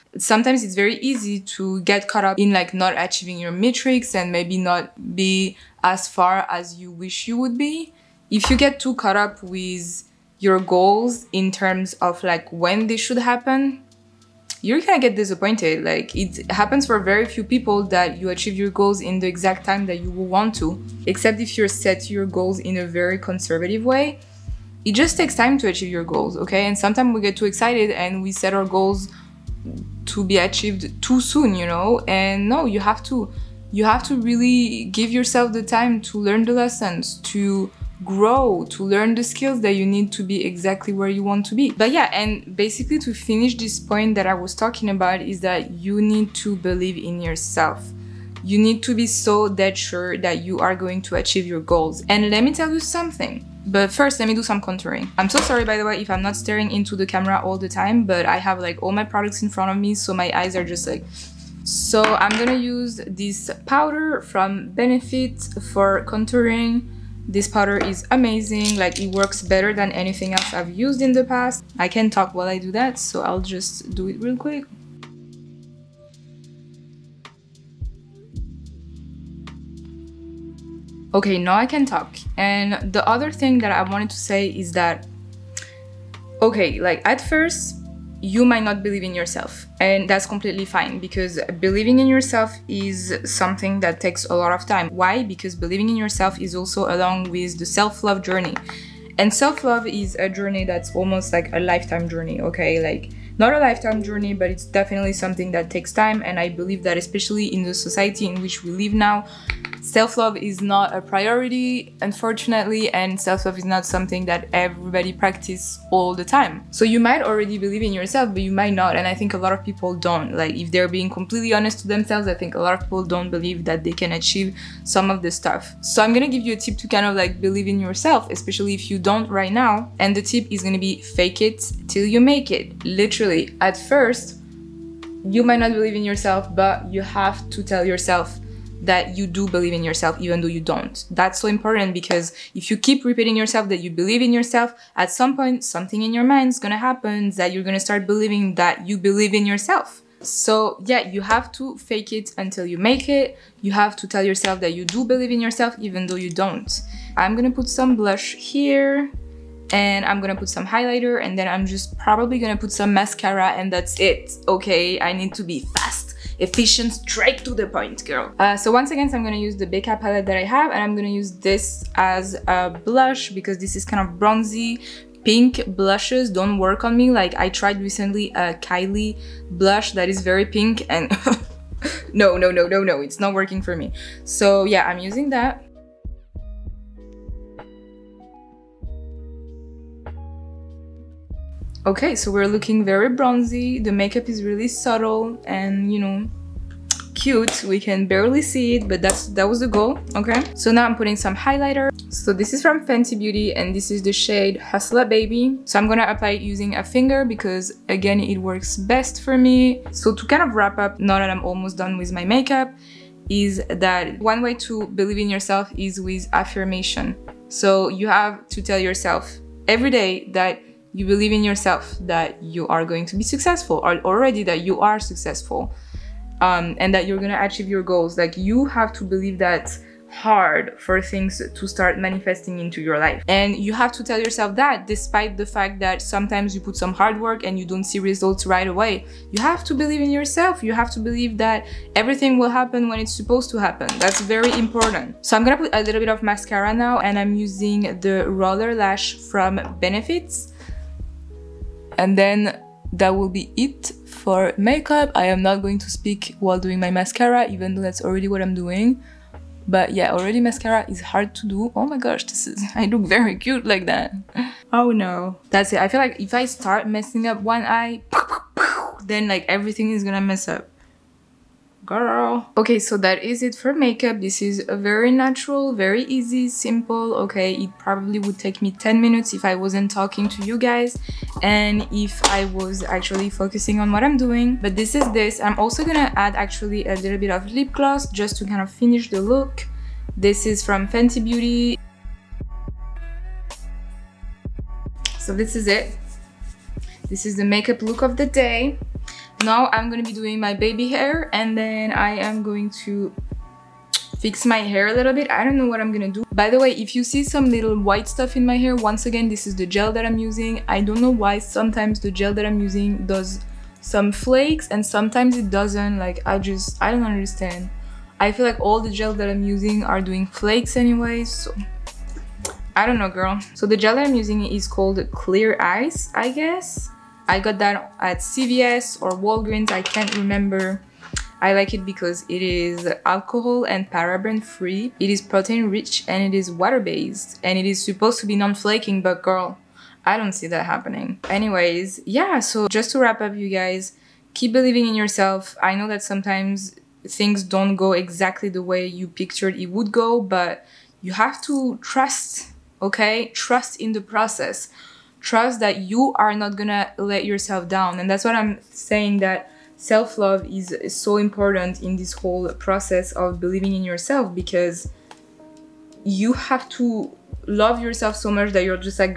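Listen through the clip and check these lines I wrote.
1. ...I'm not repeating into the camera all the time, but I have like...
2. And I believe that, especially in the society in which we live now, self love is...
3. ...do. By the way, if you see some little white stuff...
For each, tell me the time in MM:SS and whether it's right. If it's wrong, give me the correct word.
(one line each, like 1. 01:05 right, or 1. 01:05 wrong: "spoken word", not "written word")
1. 00:56 wrong: "staring", not "repeating"
2. 01:46 right
3. 05:06 right.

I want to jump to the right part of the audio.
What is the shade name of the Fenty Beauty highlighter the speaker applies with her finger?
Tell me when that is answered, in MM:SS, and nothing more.
03:24.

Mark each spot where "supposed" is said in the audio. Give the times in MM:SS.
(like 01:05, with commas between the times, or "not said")
04:03, 05:37.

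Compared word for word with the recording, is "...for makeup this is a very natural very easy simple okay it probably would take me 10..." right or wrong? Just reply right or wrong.
right.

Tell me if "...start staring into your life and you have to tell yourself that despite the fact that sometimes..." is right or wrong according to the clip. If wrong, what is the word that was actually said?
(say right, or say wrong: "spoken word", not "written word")
wrong: "manifesting", not "staring".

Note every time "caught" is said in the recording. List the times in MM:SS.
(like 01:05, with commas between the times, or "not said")
00:02, 00:08.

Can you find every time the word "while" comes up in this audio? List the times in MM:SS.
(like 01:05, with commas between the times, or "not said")
01:12, 04:16.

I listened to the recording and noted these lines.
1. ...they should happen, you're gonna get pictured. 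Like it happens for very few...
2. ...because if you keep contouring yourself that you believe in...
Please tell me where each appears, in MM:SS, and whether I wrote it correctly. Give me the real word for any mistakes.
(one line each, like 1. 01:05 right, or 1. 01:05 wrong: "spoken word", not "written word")
1. 00:12 wrong: "disappointed", not "pictured"
2. 02:21 wrong: "repeating", not "contouring".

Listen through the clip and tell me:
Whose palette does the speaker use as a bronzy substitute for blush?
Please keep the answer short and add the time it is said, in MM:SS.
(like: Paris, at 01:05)
Becca, at 02:49.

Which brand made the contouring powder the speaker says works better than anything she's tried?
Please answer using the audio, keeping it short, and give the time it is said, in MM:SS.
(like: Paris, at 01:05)
Benefit, at 01:04.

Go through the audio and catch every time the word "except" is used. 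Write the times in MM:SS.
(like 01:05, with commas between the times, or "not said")
00:21.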